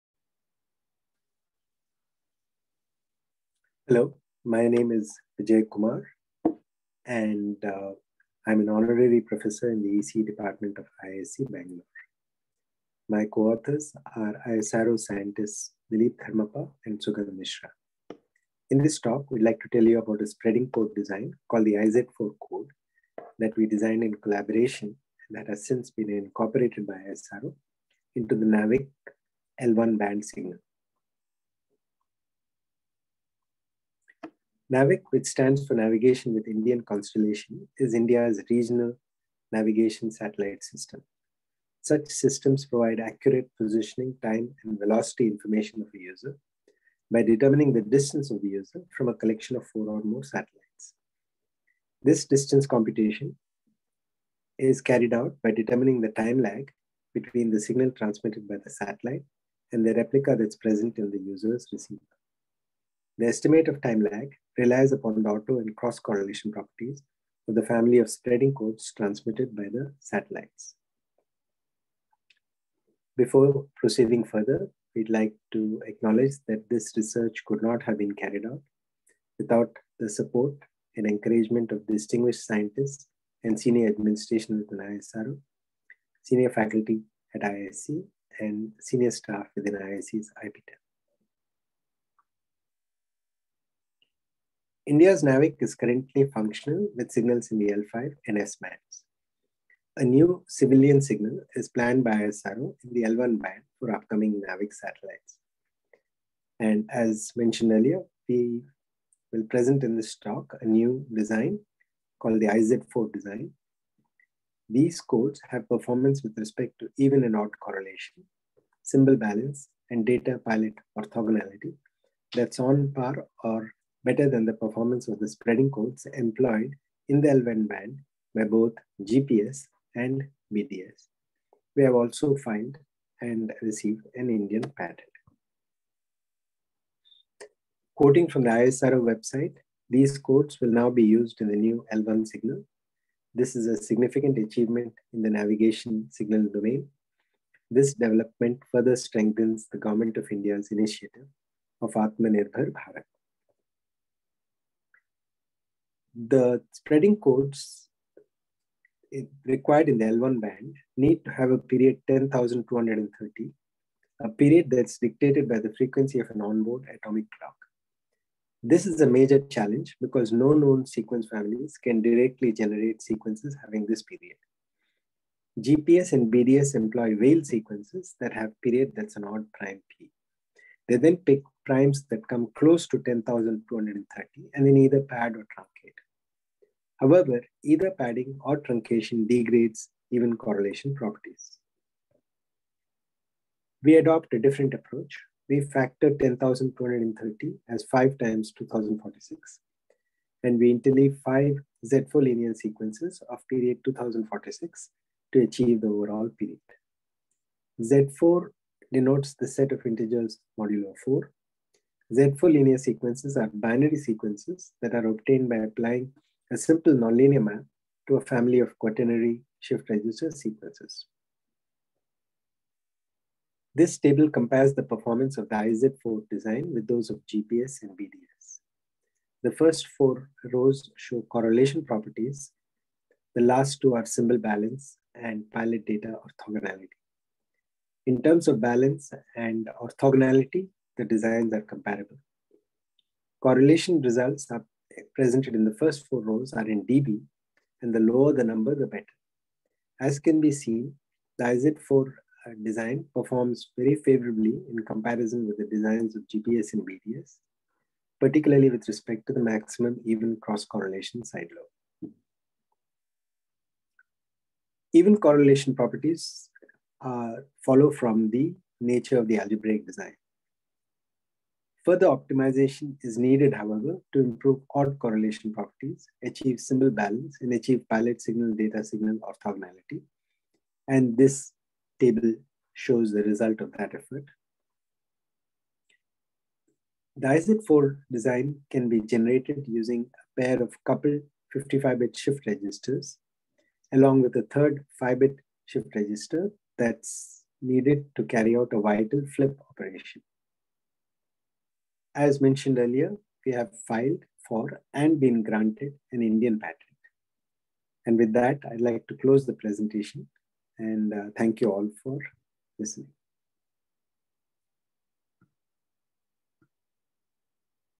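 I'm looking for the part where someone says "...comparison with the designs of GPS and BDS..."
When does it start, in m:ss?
4:14.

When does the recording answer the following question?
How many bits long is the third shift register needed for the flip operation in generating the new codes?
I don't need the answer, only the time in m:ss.
4:55.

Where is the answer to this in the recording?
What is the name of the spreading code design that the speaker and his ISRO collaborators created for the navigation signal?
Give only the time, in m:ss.
0:21.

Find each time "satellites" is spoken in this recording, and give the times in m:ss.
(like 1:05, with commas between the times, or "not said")
0:40, 0:50, 0:58, 1:09, 1:44.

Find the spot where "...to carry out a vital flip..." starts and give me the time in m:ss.
4:58.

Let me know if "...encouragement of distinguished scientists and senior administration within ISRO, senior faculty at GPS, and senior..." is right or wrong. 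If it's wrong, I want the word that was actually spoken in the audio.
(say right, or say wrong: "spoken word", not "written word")
wrong: "IISc", not "GPS".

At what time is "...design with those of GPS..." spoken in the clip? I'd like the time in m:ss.
3:46.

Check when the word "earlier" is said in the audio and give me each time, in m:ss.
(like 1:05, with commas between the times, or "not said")
1:47, 5:02.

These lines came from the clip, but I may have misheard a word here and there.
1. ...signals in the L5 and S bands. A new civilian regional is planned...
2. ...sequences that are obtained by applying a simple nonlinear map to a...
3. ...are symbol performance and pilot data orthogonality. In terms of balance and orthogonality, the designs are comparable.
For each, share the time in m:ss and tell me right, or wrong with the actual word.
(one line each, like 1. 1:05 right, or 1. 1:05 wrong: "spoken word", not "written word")
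1. 1:37 wrong: "signal", not "regional"
2. 3:33 right
3. 3:53 wrong: "balance", not "performance".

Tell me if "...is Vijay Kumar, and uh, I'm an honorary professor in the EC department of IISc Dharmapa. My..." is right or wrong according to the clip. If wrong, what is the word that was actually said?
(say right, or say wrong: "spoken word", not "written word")
wrong: "Bangalore", not "Dharmapa".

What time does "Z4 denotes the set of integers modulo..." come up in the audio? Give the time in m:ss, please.
3:27.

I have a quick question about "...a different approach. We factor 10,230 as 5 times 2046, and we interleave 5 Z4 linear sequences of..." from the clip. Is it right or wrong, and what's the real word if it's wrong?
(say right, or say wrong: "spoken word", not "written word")
right.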